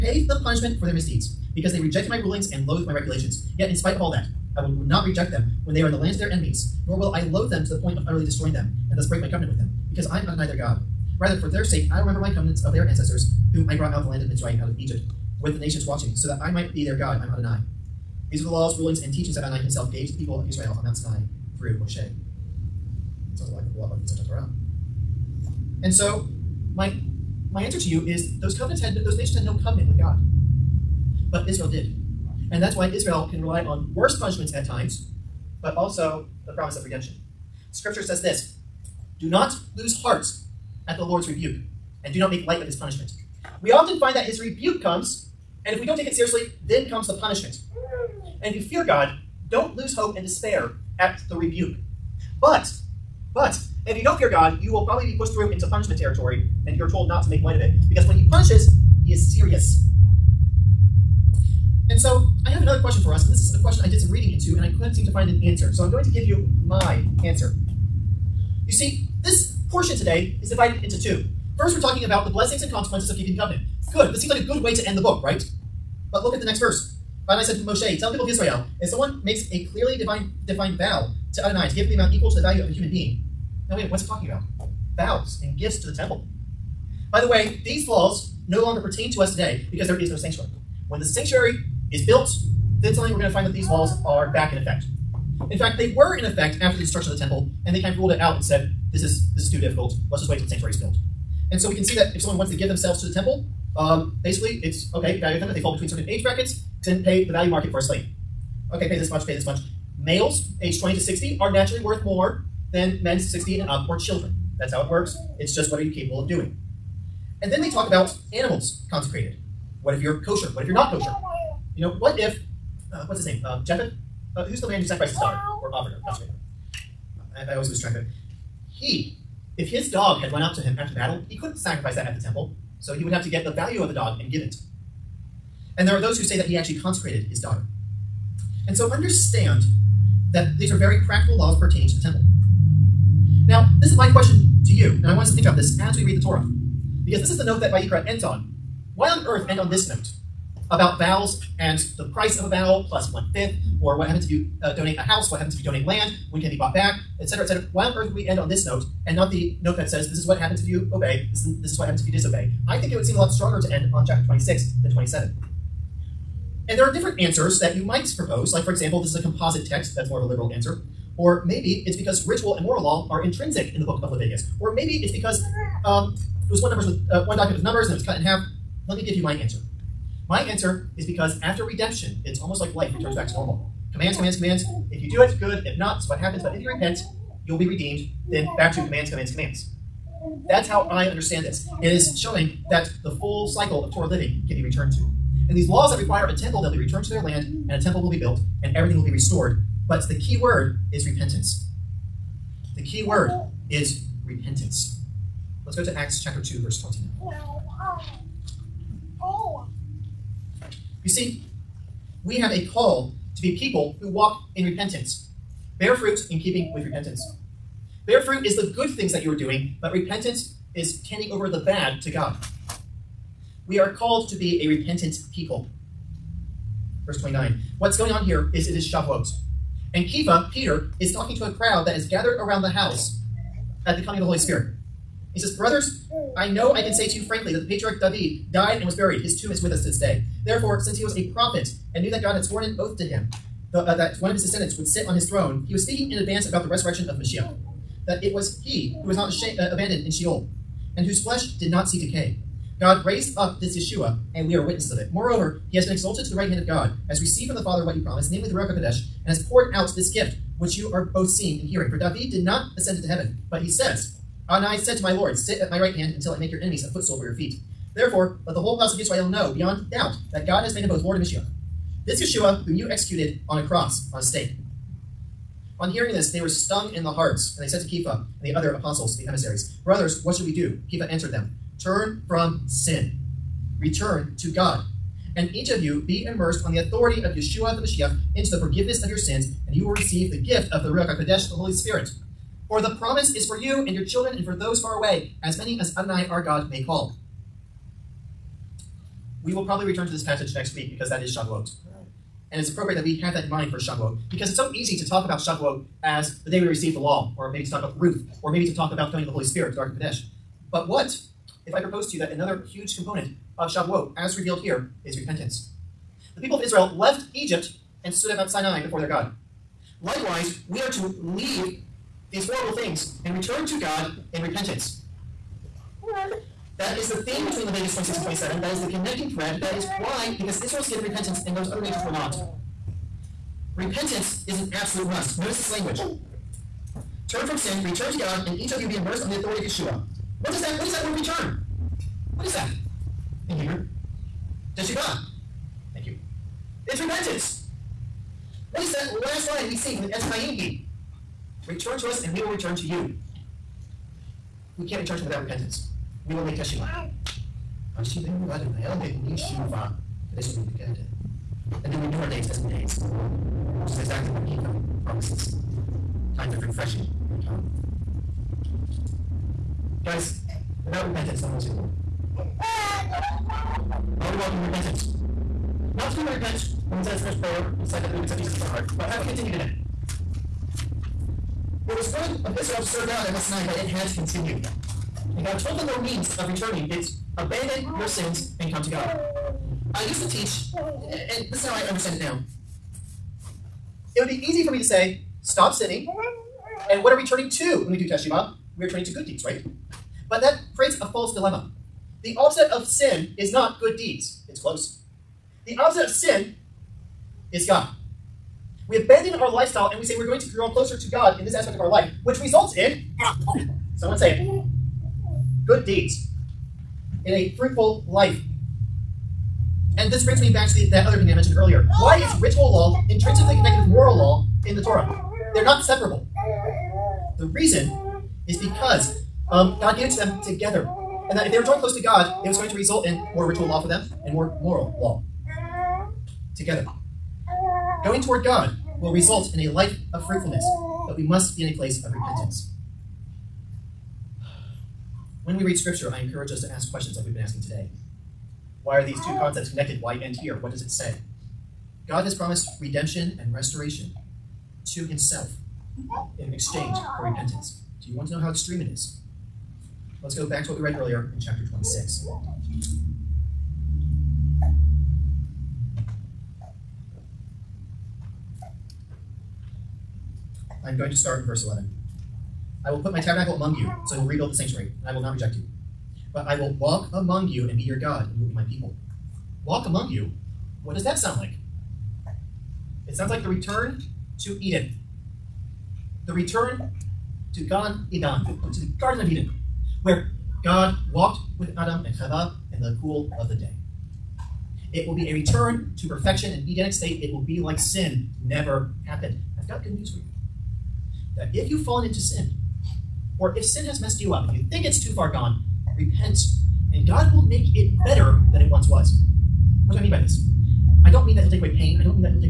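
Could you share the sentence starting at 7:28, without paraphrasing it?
Why are these two concepts connected?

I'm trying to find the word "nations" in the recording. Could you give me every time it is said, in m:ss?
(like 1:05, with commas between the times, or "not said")
0:15, 0:29, 5:31.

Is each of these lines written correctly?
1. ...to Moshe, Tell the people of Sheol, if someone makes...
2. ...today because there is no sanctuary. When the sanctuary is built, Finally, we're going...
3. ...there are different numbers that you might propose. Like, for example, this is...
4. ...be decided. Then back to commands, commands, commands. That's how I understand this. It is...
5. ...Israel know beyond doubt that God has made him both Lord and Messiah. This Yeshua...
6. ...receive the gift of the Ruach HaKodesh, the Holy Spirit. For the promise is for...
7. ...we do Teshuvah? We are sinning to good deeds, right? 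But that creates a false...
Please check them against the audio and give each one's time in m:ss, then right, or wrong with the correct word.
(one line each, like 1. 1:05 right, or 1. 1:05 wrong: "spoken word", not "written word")
1. 1:17 wrong: "Israel", not "Sheol"
2. 1:29 right
3. 2:46 wrong: "answers", not "numbers"
4. 3:07 wrong: "redeemed", not "decided"
5. 4:28 right
6. 4:49 right
7. 6:37 wrong: "turning", not "sinning".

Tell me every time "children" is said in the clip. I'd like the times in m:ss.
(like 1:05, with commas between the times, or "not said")
1:53, 4:54.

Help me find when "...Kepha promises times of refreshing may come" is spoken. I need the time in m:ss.
6:04.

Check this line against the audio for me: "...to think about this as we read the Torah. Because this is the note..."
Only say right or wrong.
right.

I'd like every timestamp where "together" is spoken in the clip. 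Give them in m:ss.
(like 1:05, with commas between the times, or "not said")
7:10, 7:16.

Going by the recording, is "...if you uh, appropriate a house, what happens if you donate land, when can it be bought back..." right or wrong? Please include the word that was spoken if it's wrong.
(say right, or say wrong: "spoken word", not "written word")
wrong: "donate", not "appropriate".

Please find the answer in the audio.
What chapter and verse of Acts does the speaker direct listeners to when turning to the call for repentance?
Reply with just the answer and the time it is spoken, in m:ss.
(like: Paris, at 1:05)
Acts 2:29, at 3:25.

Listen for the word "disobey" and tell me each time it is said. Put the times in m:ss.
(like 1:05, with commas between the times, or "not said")
2:42.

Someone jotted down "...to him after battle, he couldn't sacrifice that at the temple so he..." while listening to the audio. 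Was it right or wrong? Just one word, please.
right.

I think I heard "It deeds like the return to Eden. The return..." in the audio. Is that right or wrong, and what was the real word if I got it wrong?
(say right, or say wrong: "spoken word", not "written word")
wrong: "sounds", not "deeds".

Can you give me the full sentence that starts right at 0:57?
Because when He punishes, He is serious.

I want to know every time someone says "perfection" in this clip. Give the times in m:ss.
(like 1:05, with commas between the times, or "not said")
8:16.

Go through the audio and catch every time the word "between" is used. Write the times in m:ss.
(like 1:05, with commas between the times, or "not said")
1:45, 5:27.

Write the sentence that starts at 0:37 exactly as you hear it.
Scripture says this Do not lose heart at the Lord's rebuke, and do not make light of his punishment.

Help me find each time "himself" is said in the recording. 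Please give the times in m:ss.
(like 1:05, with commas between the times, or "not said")
0:19, 7:35.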